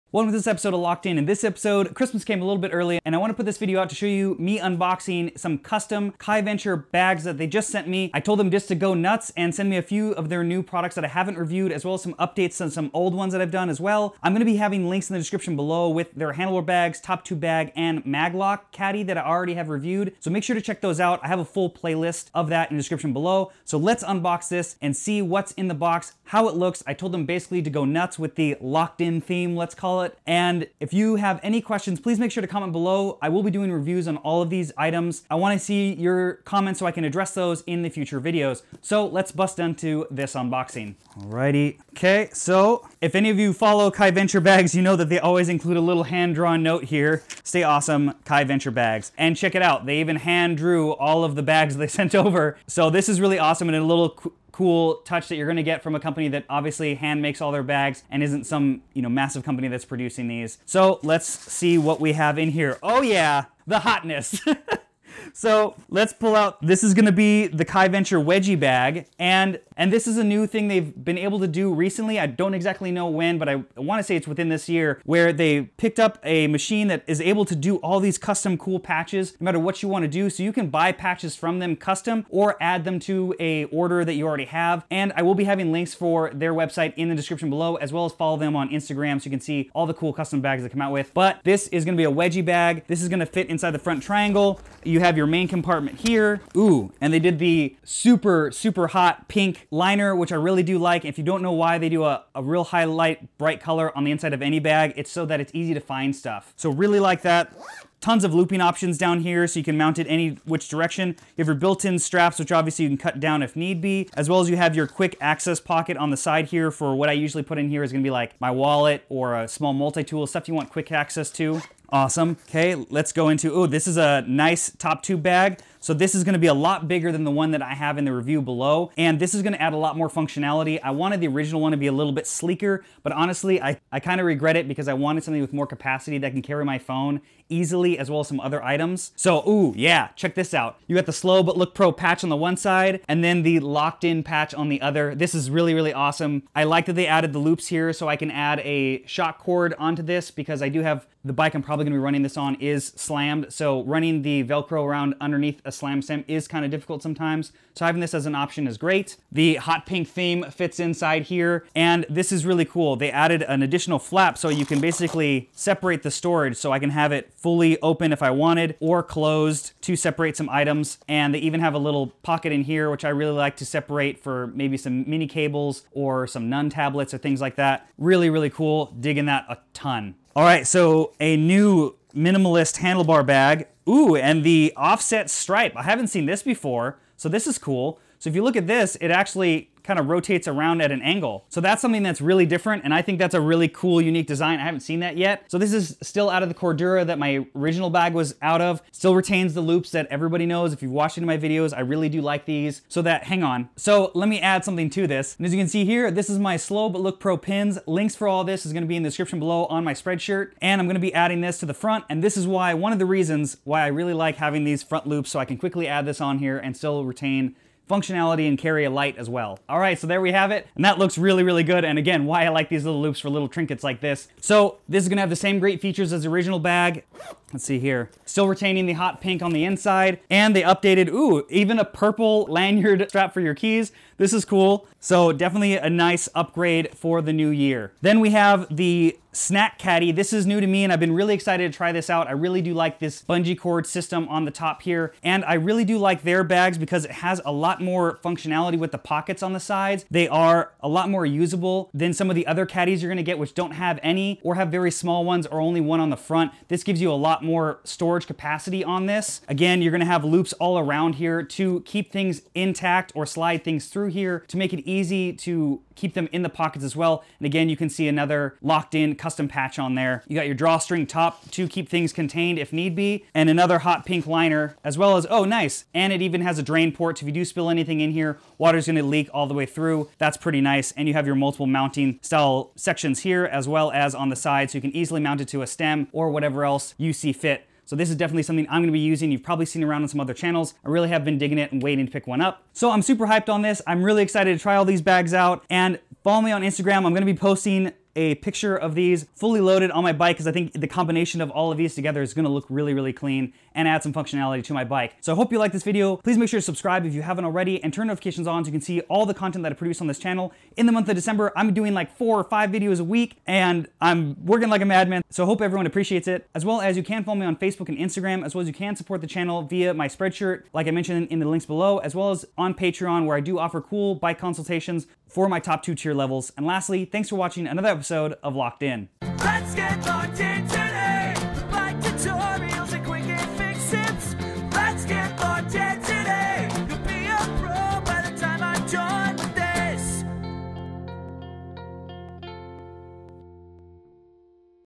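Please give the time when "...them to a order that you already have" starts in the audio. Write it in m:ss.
1:22.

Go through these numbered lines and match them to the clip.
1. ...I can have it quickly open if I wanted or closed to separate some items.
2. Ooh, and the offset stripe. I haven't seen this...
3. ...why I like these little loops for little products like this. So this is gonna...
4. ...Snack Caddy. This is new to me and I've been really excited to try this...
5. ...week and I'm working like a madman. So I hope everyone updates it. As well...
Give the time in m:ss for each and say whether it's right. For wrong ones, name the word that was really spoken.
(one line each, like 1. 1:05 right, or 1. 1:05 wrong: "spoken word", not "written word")
1. 2:46 wrong: "fully", not "quickly"
2. 3:03 right
3. 3:42 wrong: "trinkets", not "products"
4. 3:59 right
5. 5:13 wrong: "appreciates", not "updates".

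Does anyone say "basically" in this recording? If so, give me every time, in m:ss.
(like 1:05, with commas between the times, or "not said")
0:27, 2:44.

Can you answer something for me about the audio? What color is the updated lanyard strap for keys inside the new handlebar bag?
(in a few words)
purple.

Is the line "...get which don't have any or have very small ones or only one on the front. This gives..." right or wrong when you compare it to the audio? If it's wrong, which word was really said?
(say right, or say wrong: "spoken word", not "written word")
right.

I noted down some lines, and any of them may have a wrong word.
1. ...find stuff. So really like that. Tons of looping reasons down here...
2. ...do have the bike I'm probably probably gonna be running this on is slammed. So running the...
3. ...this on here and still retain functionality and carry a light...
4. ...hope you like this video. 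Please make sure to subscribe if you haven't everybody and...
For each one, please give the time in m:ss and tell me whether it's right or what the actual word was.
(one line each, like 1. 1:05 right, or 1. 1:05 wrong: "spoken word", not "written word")
1. 1:45 wrong: "options", not "reasons"
2. 2:30 right
3. 3:36 right
4. 5:05 wrong: "already", not "everybody".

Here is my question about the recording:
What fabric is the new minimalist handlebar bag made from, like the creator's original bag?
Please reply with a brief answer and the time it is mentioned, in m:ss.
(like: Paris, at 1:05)
Cordura, at 3:16.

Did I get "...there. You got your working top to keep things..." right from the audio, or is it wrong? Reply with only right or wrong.
wrong.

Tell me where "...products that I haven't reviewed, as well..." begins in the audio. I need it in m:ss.
0:10.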